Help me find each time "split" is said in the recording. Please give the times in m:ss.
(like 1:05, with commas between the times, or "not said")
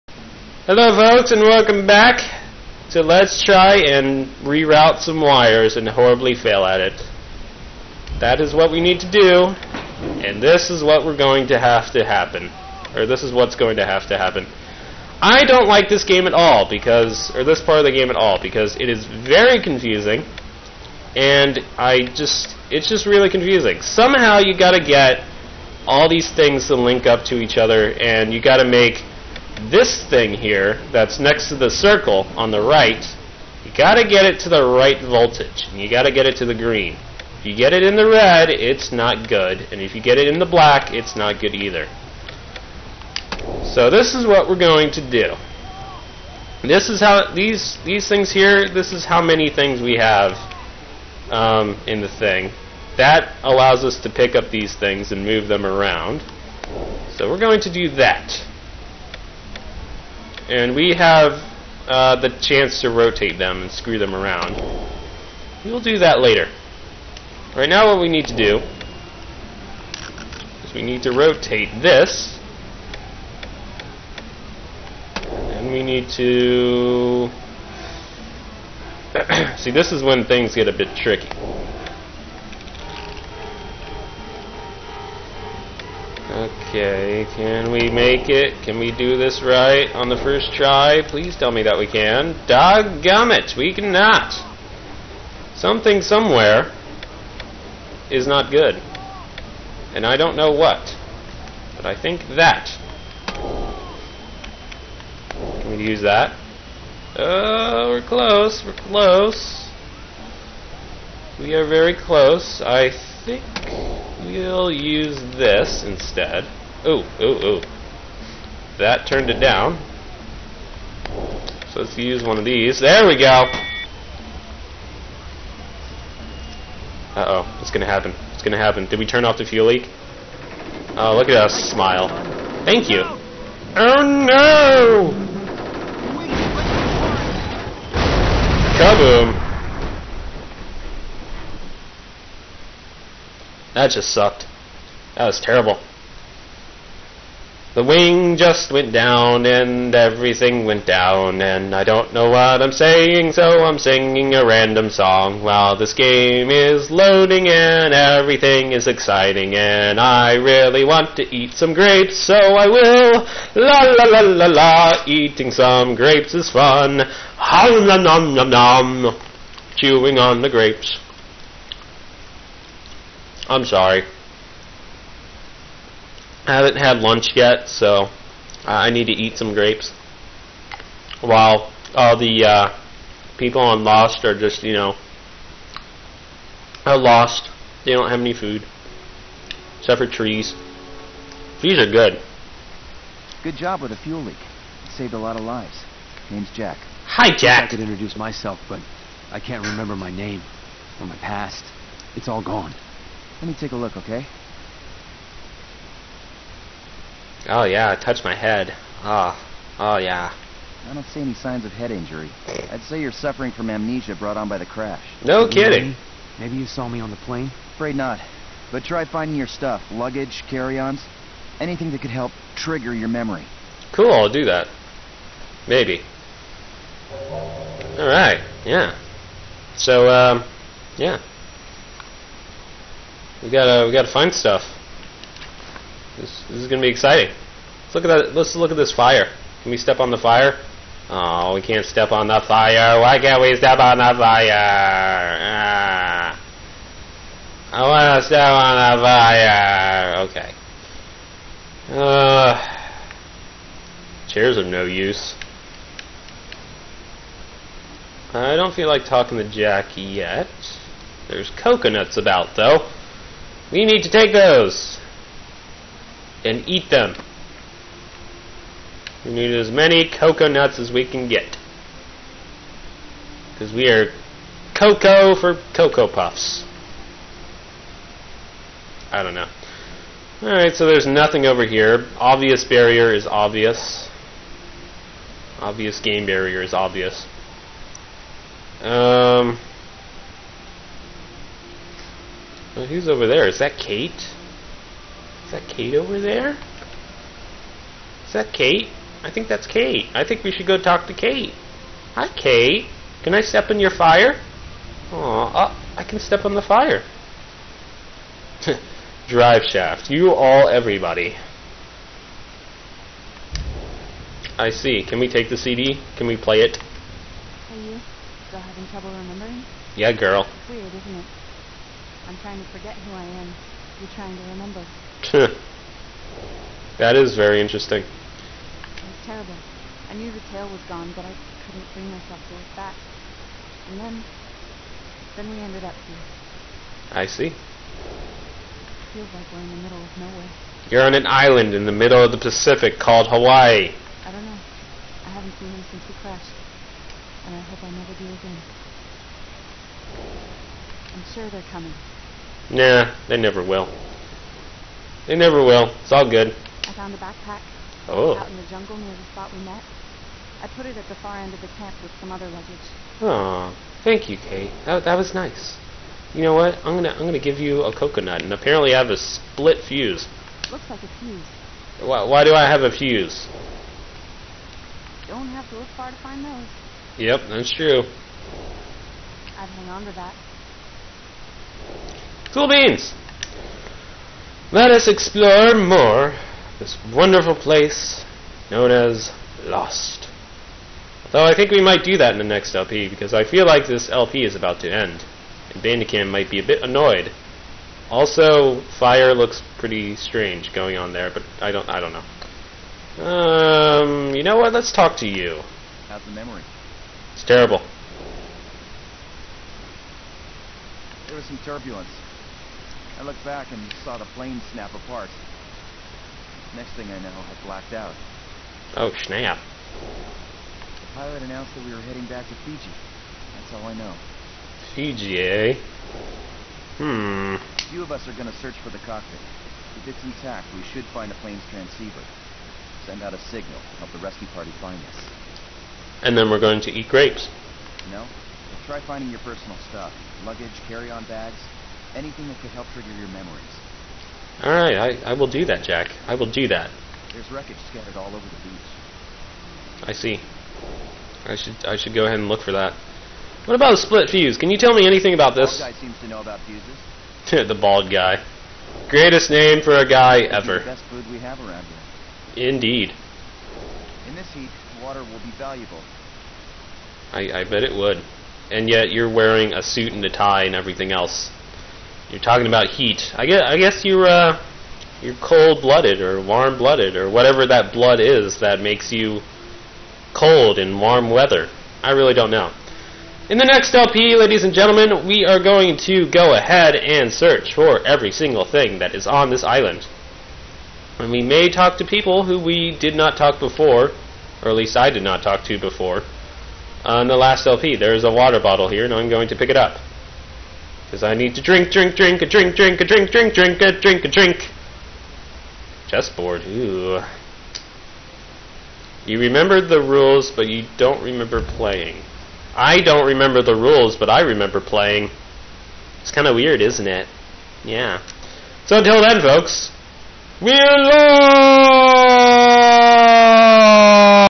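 6:09, 7:33.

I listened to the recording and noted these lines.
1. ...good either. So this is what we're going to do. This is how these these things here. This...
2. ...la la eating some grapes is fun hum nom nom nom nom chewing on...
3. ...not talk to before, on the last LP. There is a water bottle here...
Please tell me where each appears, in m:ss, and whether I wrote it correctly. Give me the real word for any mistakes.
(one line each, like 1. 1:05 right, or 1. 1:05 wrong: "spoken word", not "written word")
1. 0:41 right
2. 2:44 right
3. 8:15 right.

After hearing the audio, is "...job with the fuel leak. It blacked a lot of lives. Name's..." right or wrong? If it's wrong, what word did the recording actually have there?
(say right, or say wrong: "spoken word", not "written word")
wrong: "saved", not "blacked".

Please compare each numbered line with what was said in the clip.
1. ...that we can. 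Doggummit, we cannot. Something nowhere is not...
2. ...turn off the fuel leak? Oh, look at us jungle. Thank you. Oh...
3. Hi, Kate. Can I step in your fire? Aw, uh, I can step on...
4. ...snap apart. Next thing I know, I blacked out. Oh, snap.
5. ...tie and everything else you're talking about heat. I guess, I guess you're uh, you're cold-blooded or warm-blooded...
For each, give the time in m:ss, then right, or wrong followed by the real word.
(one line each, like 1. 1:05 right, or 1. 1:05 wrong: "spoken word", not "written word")
1. 1:31 wrong: "somewhere", not "nowhere"
2. 2:09 wrong: "smile", not "jungle"
3. 5:02 right
4. 6:54 right
5. 7:50 right.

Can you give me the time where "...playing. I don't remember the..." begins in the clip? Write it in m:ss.
8:31.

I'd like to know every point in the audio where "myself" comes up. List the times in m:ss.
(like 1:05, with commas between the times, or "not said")
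3:18, 5:32.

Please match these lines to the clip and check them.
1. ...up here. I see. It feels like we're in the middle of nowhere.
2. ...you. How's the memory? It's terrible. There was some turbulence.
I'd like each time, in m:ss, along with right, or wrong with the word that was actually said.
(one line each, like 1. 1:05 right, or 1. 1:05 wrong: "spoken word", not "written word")
1. 5:35 right
2. 6:45 right.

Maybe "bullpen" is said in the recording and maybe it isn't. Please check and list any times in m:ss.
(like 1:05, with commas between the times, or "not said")
not said.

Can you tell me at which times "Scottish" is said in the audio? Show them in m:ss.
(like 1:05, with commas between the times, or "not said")
not said.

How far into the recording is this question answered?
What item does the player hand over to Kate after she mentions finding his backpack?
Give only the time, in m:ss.
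6:07.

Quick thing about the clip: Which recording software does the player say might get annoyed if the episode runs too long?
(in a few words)
Bandicam.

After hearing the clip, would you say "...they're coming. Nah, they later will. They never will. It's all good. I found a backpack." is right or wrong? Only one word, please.
wrong.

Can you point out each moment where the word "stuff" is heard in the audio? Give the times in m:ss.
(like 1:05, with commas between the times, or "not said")
3:39, 3:54, 7:19.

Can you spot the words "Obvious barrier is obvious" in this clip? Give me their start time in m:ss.
4:42.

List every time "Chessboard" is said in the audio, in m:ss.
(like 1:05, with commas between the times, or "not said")
8:26.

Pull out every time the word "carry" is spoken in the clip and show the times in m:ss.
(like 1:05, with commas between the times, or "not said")
3:40, 7:20.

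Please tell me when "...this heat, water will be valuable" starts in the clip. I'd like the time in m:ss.
7:44.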